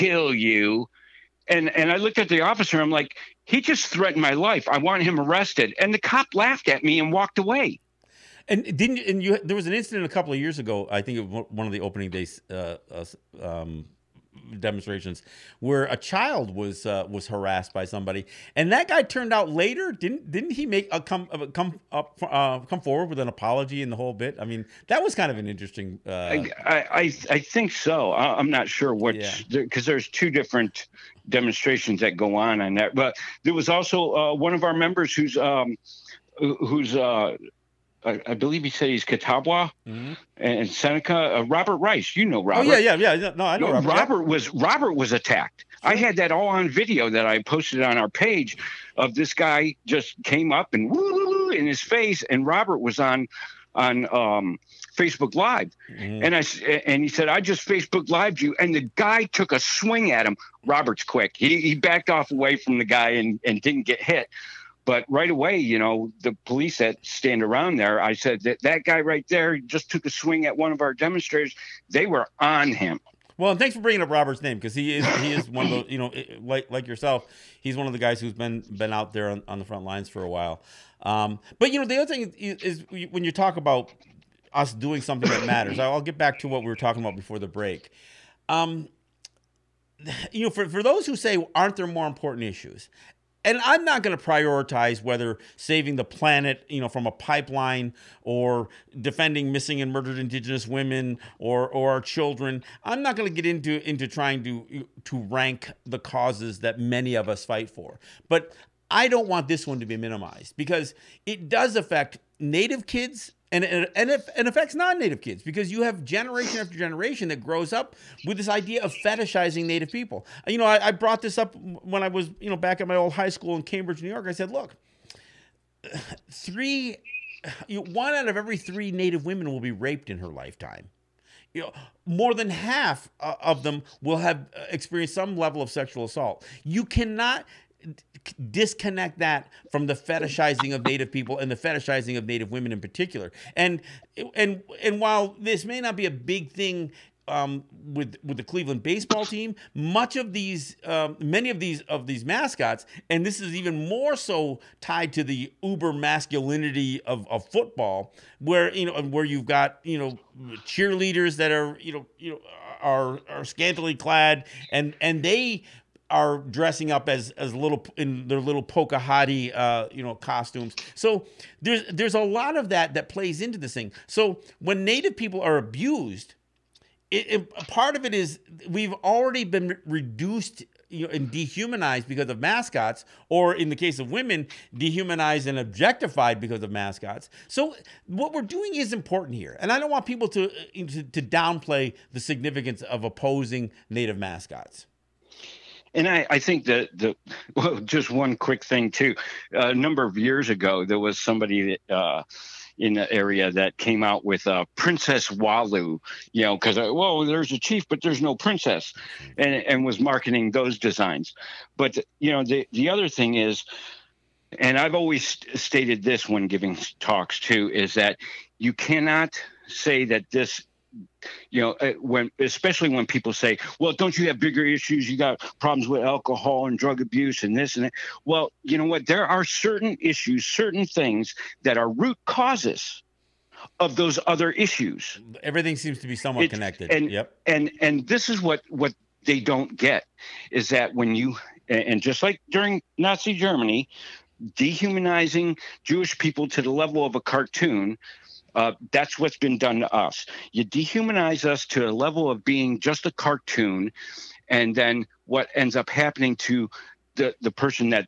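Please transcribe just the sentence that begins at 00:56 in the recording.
and I and he said, "I just Facebook Lived you," and the guy took a swing at him.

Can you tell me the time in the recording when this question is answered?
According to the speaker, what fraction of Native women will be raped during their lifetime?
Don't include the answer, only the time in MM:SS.
02:07.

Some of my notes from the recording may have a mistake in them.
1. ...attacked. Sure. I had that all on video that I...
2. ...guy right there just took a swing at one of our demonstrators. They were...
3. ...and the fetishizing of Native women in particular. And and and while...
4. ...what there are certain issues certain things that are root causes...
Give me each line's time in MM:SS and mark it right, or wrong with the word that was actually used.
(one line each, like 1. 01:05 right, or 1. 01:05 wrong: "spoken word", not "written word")
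1. 00:45 right
2. 01:08 right
3. 02:21 right
4. 03:48 right.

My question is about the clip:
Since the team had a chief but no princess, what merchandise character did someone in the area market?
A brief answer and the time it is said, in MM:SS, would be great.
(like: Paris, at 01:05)
Princess Walu, at 03:24.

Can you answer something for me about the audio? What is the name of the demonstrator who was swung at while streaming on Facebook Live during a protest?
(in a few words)
Robert Rice.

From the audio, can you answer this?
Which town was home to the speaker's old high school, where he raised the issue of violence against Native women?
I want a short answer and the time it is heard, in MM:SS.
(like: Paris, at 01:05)
Cambridge, New York, at 02:03.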